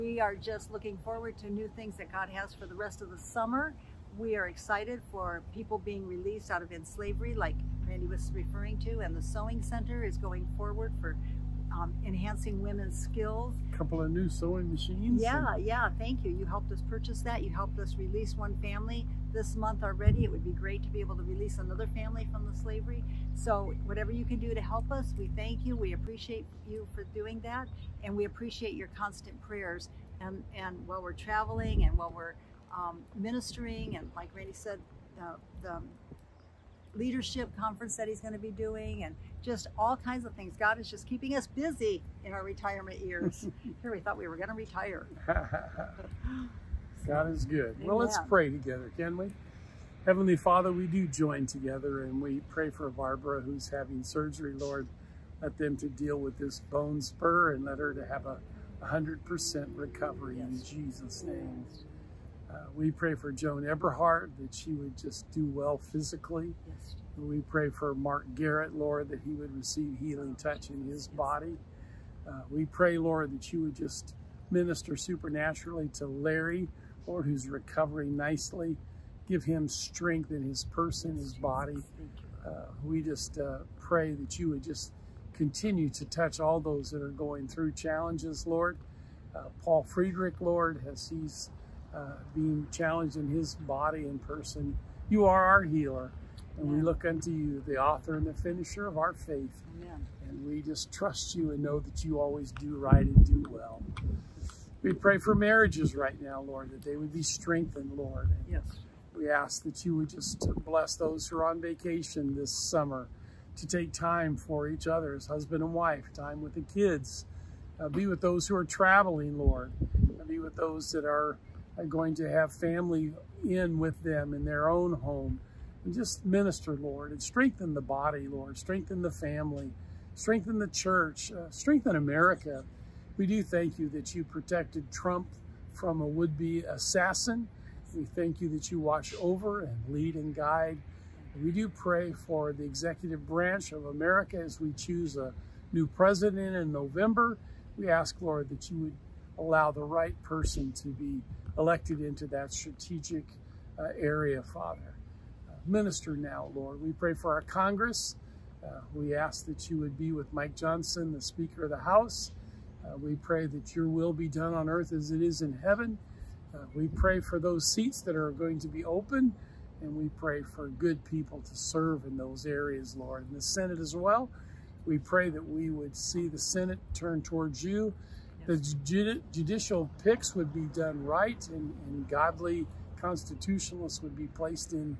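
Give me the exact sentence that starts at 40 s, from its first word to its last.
God is just keeping us busy in our retirement years.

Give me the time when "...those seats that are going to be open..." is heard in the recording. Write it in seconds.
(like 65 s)
167 s.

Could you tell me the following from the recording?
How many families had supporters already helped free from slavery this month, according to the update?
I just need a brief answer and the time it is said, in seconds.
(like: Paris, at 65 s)
1, at 18 s.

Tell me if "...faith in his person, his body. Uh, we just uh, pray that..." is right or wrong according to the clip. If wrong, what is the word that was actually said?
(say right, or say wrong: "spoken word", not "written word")
wrong: "strength", not "faith".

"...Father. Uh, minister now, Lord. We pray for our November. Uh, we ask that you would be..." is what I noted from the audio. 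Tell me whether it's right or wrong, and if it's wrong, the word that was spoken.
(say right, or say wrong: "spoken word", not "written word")
wrong: "Congress", not "November".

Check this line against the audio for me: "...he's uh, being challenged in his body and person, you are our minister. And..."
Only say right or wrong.
wrong.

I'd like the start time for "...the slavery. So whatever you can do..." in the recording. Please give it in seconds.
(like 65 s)
22 s.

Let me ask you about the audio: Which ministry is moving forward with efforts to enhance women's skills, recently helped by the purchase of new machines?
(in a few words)
Sewing Center.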